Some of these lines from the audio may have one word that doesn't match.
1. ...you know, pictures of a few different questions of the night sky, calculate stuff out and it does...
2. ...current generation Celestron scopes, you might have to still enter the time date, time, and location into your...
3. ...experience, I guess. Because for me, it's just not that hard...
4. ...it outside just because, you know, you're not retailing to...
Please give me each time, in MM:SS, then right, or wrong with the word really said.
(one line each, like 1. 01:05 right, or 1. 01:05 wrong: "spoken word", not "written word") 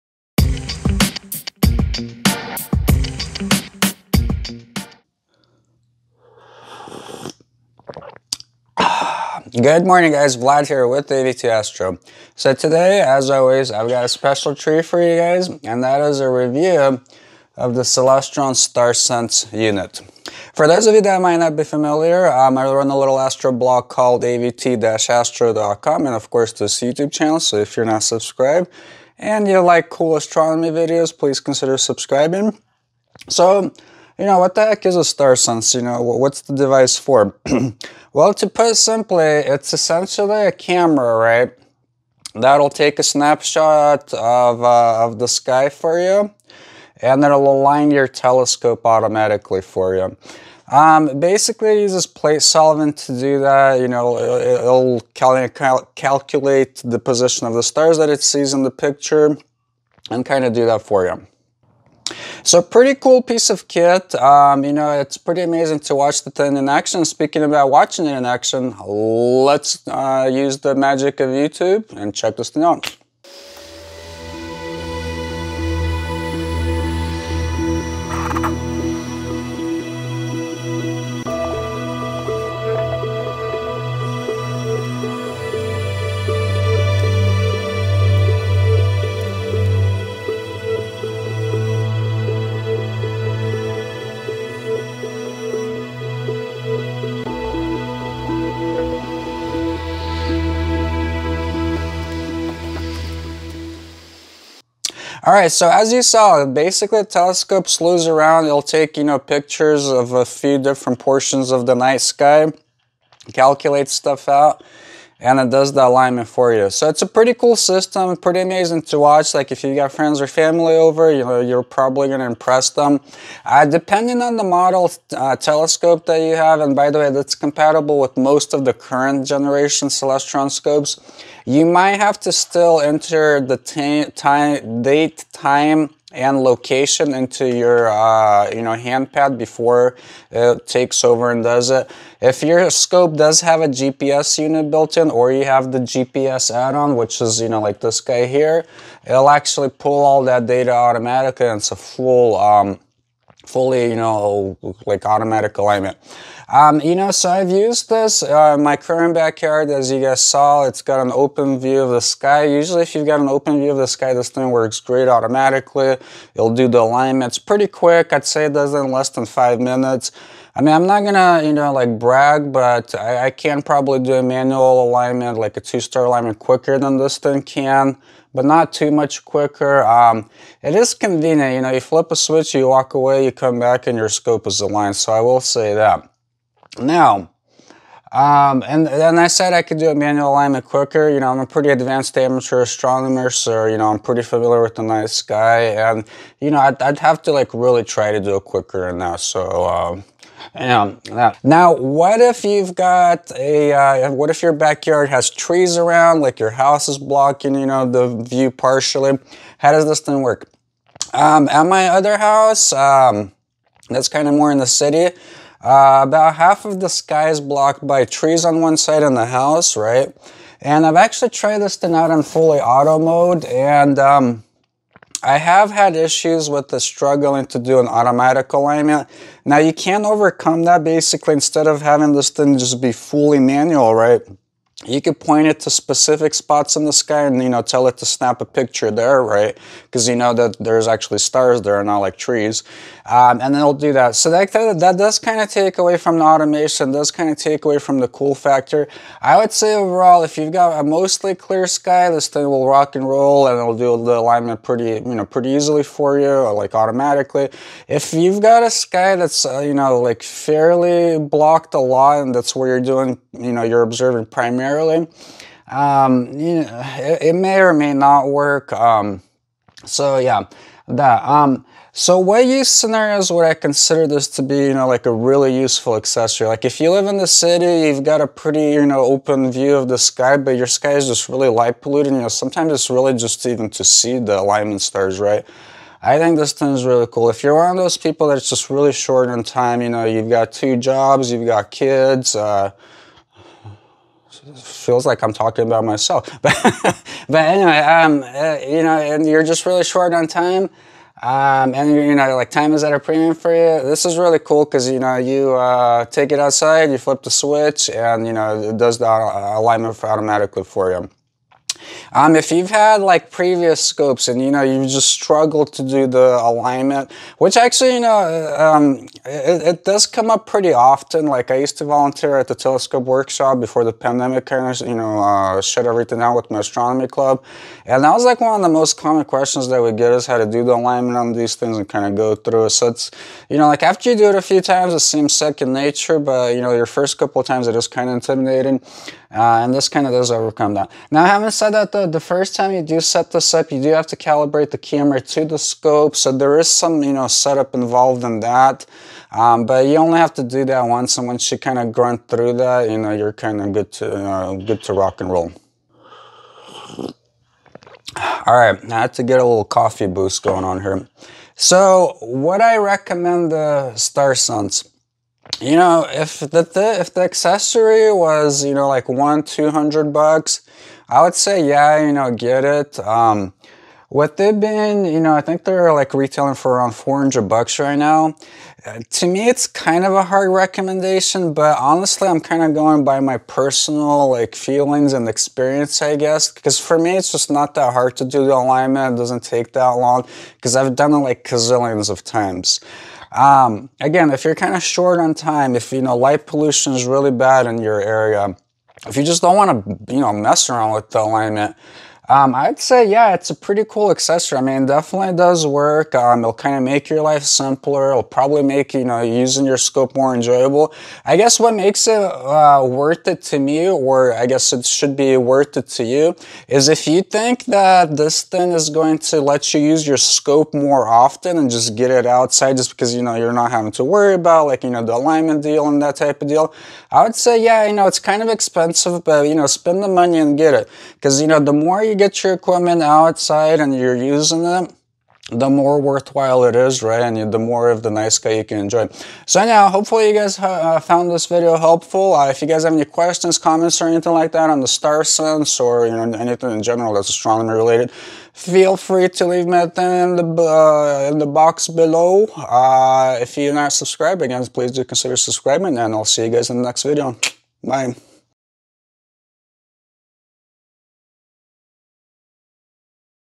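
1. 01:48 wrong: "portions", not "questions"
2. 02:08 right
3. 06:25 right
4. 07:02 wrong: "having", not "retailing".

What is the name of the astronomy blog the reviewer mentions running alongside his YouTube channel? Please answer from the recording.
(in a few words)
avt-astro.com.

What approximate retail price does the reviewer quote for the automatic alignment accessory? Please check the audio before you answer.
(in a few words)
$400.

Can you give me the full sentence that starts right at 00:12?
So today, as always, I've got a special treat for you guys, and that is a review of the Celestron Star unit.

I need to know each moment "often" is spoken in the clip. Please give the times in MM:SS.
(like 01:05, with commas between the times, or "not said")
05:20, 07:01.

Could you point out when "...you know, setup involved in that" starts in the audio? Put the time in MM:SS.
05:47.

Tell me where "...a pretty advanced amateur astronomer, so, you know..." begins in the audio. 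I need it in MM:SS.
03:11.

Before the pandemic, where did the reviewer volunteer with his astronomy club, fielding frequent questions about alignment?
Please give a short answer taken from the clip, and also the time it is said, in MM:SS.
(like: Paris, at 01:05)
telescope workshop, at 05:22.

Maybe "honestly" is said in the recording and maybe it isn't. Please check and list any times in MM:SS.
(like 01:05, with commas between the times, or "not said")
06:21.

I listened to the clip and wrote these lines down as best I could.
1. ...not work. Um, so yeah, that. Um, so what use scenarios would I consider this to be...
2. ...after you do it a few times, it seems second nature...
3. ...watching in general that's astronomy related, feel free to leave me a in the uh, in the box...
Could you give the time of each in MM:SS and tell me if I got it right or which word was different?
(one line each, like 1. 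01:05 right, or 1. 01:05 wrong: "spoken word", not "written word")
1. 04:27 right
2. 05:33 right
3. 07:26 wrong: "anything", not "watching".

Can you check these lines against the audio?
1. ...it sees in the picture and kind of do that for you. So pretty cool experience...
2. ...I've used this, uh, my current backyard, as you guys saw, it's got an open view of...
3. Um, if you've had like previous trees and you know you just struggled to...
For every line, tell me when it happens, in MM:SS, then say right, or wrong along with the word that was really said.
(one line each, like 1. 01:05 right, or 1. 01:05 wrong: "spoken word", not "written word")
1. 00:58 wrong: "piece", not "experience"
2. 02:37 right
3. 05:12 wrong: "scopes", not "trees".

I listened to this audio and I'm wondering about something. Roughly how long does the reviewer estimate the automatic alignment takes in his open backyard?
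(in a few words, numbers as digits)
less than 5 minutes.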